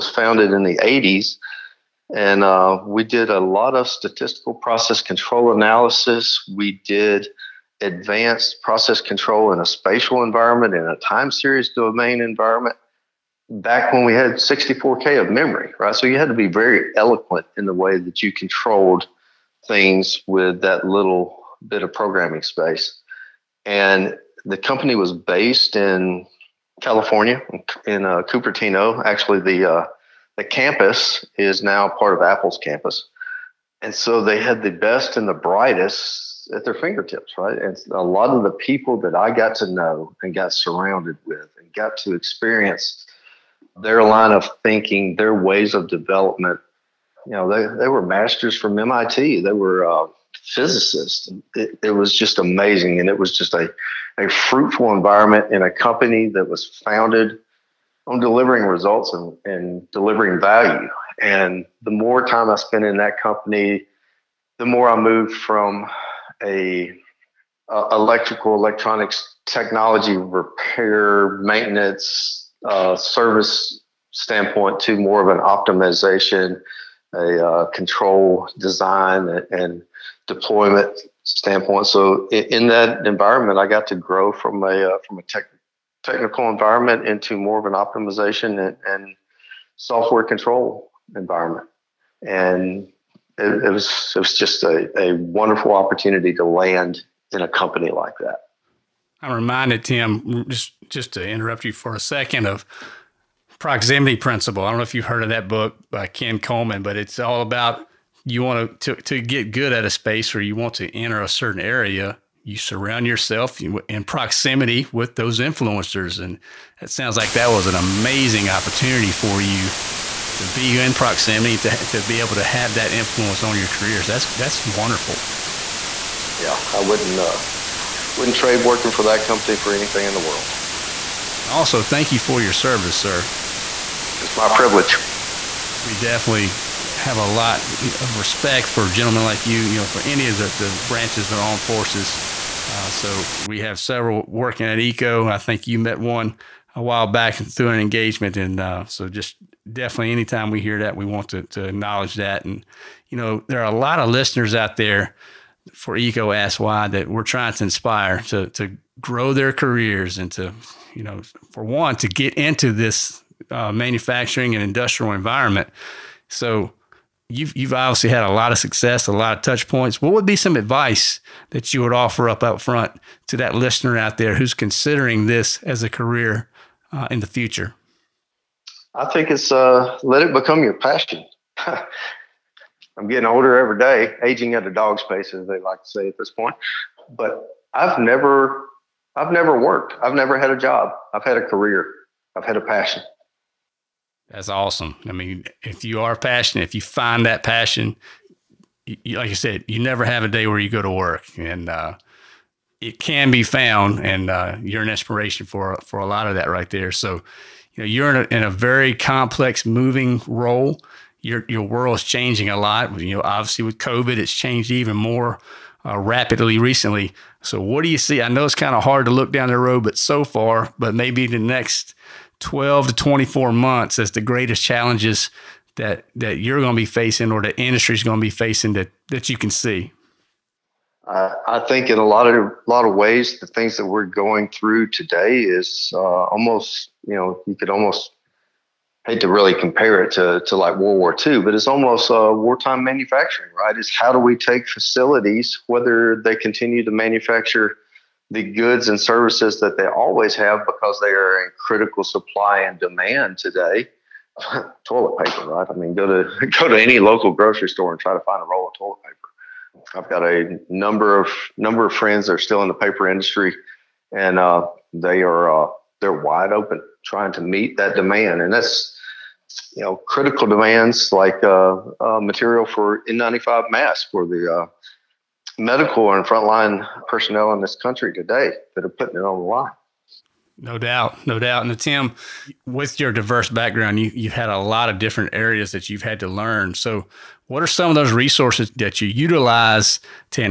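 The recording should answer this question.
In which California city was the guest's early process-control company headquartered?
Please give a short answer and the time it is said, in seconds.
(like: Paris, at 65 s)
Cupertino, at 28 s.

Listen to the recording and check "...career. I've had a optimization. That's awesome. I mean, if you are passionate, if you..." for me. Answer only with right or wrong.
wrong.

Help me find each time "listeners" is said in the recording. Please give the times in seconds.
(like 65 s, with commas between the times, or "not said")
154 s, 173 s.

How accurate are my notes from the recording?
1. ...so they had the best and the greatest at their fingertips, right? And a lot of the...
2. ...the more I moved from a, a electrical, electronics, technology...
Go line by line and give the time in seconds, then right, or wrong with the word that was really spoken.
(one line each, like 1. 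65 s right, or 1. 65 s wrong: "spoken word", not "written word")
1. 33 s wrong: "brightest", not "greatest"
2. 64 s right.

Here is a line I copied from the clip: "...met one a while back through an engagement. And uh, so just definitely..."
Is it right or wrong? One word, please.
right.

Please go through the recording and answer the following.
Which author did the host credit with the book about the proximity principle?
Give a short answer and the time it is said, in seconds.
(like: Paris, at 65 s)
Ken Coleman, at 106 s.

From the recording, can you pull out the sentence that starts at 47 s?
You know, they, they were masters from MIT.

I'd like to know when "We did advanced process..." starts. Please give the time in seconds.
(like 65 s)
6 s.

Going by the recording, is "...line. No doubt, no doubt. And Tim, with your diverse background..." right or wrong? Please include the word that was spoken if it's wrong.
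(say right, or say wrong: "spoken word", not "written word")
right.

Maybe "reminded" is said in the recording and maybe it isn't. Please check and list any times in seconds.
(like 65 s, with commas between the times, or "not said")
99 s.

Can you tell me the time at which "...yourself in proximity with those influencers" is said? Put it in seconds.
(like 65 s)
113 s.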